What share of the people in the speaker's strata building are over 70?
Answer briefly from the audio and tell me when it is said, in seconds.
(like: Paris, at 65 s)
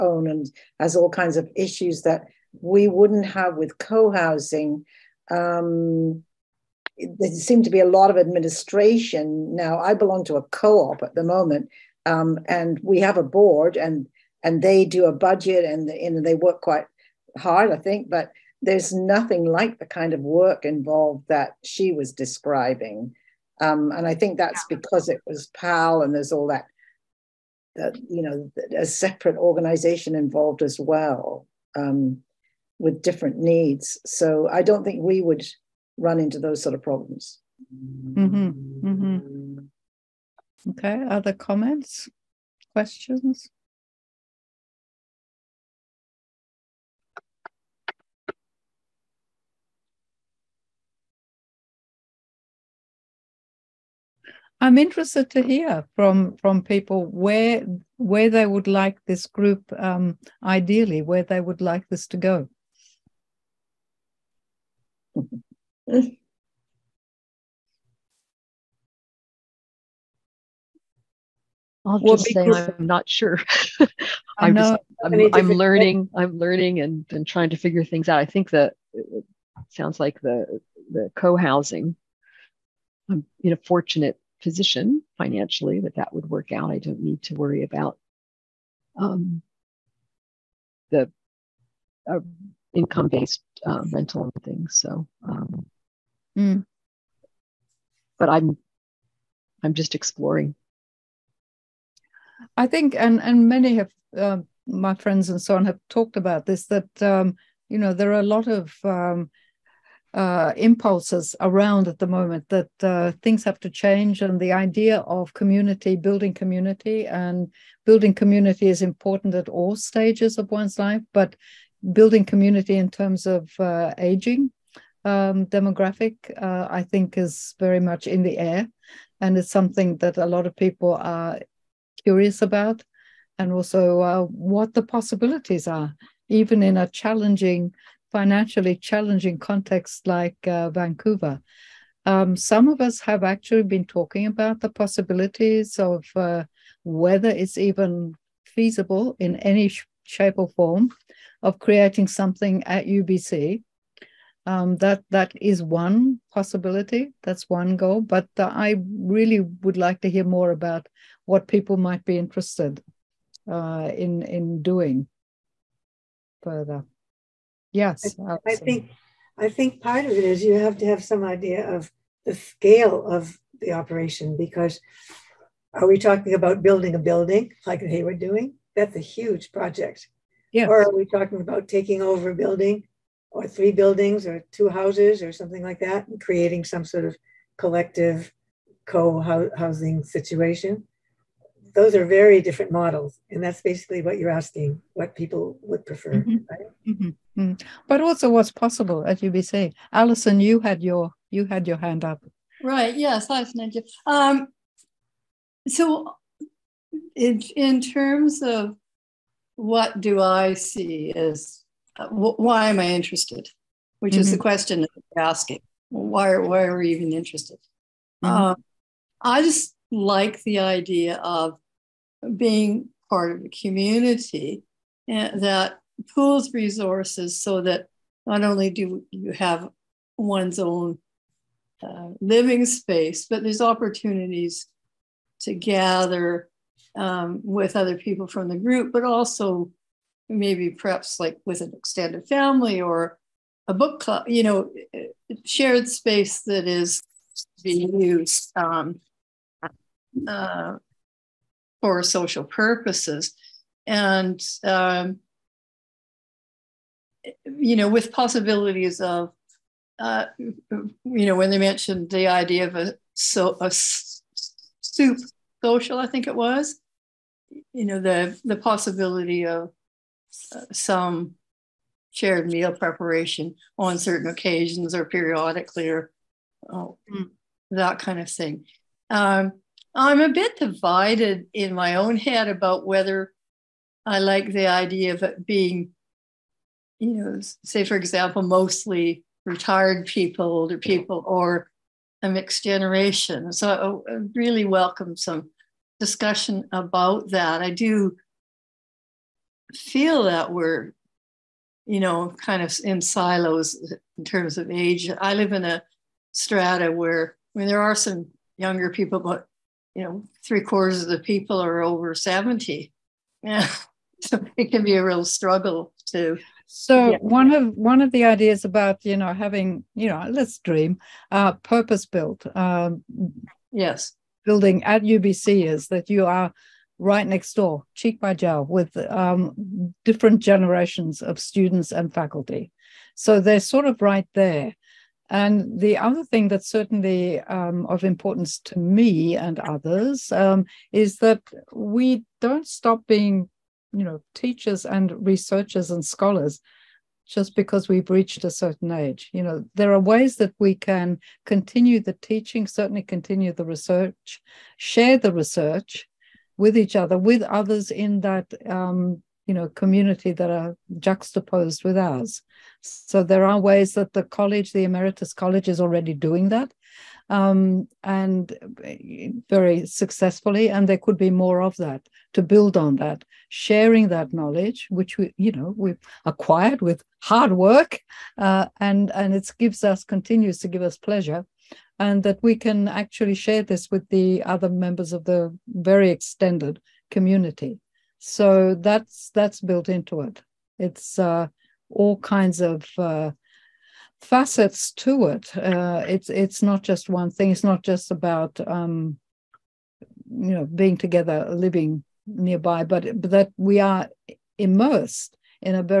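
three quarters, at 310 s.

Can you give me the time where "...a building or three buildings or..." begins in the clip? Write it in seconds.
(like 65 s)
182 s.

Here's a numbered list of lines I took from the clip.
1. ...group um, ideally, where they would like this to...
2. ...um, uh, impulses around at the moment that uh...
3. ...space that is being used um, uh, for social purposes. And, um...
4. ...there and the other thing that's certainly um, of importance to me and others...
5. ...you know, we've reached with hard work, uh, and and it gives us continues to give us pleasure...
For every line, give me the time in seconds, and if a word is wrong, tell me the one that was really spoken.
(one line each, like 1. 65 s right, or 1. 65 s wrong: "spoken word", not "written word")
1. 59 s right
2. 108 s right
3. 245 s right
4. 334 s right
5. 375 s wrong: "acquired", not "reached".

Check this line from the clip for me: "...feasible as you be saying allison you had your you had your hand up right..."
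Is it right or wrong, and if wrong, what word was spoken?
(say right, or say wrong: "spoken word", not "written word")
wrong: "possible", not "feasible".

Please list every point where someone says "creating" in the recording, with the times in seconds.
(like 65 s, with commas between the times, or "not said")
151 s, 186 s.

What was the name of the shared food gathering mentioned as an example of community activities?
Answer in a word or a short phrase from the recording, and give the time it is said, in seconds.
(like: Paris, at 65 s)
soup social, at 263 s.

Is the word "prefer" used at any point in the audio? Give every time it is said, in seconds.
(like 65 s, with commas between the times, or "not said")
195 s.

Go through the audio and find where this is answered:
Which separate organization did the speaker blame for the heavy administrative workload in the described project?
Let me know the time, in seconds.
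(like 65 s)
25 s.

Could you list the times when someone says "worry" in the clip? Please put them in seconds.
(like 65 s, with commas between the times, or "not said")
87 s.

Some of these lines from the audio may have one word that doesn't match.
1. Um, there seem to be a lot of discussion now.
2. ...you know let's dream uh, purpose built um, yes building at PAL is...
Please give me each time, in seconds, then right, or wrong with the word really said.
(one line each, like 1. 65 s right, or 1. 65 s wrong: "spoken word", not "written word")
1. 5 s wrong: "administration", not "discussion"
2. 319 s wrong: "UBC", not "PAL".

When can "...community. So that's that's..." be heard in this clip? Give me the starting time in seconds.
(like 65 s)
387 s.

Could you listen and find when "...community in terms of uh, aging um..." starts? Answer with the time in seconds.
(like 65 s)
122 s.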